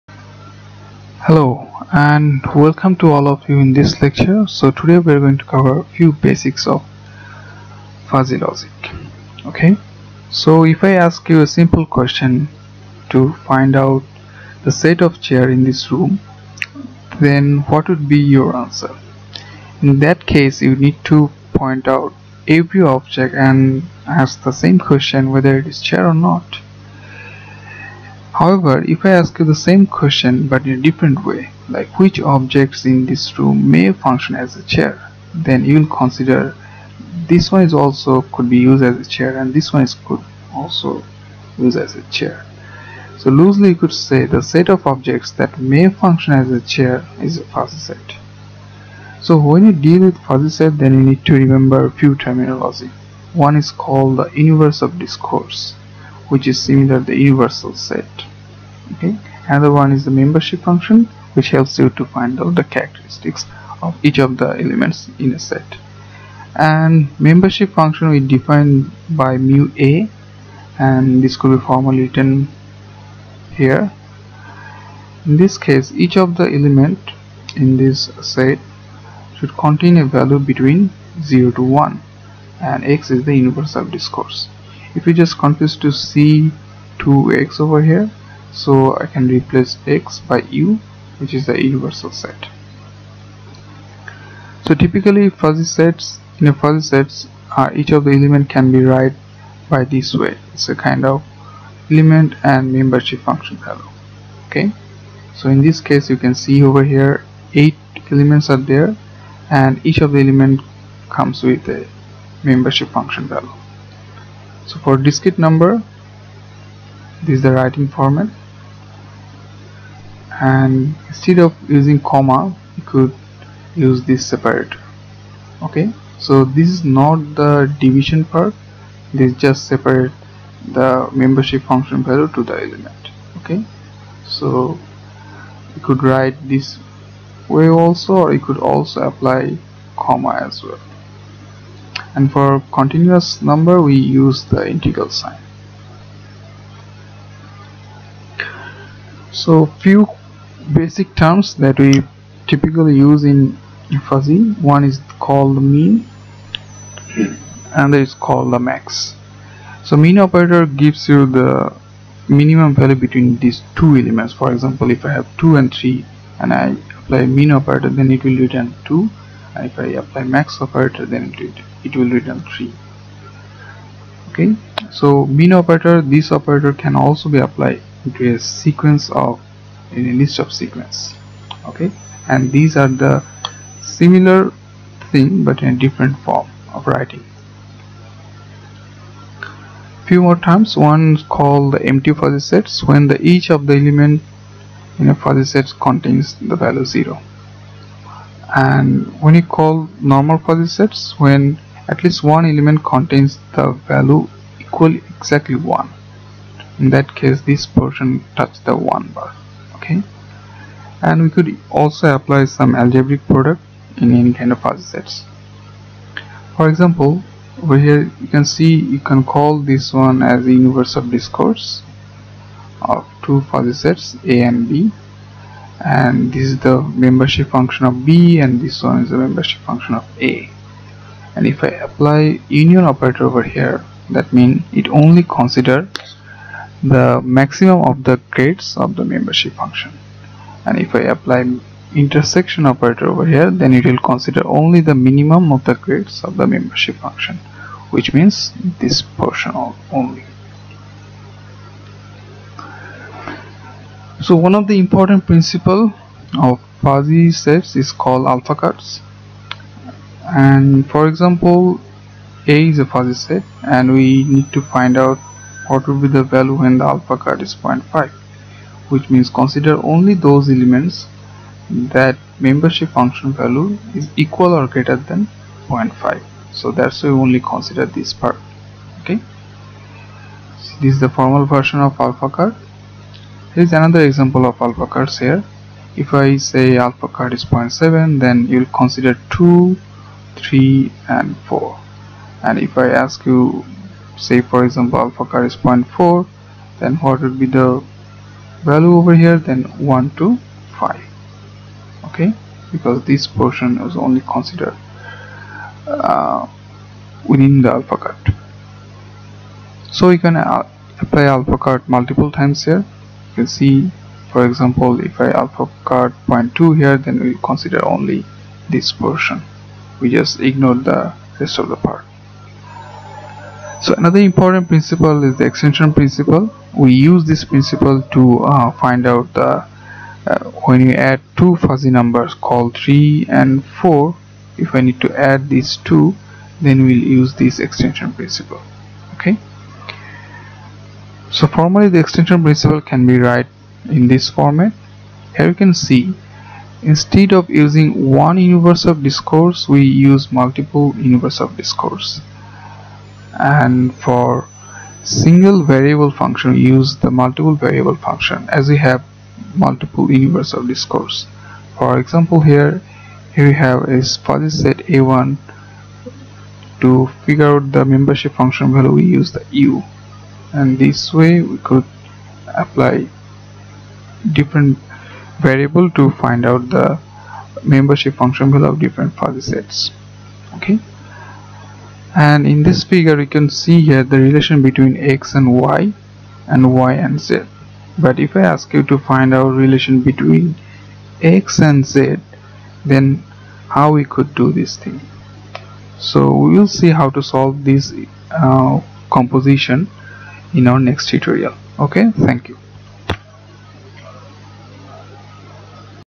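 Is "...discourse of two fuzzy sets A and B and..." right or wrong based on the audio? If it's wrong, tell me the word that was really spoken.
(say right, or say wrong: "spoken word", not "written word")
right.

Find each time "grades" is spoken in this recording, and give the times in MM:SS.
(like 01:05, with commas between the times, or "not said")
03:58, 04:05.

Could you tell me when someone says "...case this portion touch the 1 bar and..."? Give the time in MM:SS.
03:27.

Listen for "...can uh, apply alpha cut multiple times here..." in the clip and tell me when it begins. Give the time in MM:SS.
05:10.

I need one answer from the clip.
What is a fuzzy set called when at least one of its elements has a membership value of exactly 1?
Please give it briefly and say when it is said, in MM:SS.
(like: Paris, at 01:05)
normal fuzzy sets, at 03:20.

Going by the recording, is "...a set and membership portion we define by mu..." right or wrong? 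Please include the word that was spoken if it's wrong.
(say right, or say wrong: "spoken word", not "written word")
wrong: "function", not "portion".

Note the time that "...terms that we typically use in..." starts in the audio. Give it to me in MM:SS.
02:31.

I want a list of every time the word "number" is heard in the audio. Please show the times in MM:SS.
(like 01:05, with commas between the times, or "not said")
01:55, 02:23, 05:31.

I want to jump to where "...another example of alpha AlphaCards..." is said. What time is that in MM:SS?
04:43.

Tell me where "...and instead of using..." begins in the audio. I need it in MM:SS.
02:00.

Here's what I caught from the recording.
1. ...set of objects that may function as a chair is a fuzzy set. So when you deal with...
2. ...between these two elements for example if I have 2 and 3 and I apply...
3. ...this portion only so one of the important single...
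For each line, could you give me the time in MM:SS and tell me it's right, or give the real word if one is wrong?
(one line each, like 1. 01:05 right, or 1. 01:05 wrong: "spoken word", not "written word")
1. 00:44 right
2. 02:42 right
3. 04:08 wrong: "principle", not "single".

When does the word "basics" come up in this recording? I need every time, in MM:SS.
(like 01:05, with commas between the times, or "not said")
00:06, 02:30.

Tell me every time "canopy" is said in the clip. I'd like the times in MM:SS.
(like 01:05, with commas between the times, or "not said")
not said.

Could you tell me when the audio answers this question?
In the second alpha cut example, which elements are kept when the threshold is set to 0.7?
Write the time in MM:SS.
04:49.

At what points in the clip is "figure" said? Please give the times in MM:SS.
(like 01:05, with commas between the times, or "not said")
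06:07, 06:22.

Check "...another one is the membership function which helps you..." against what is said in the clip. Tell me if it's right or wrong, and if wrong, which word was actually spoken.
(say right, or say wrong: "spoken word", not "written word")
right.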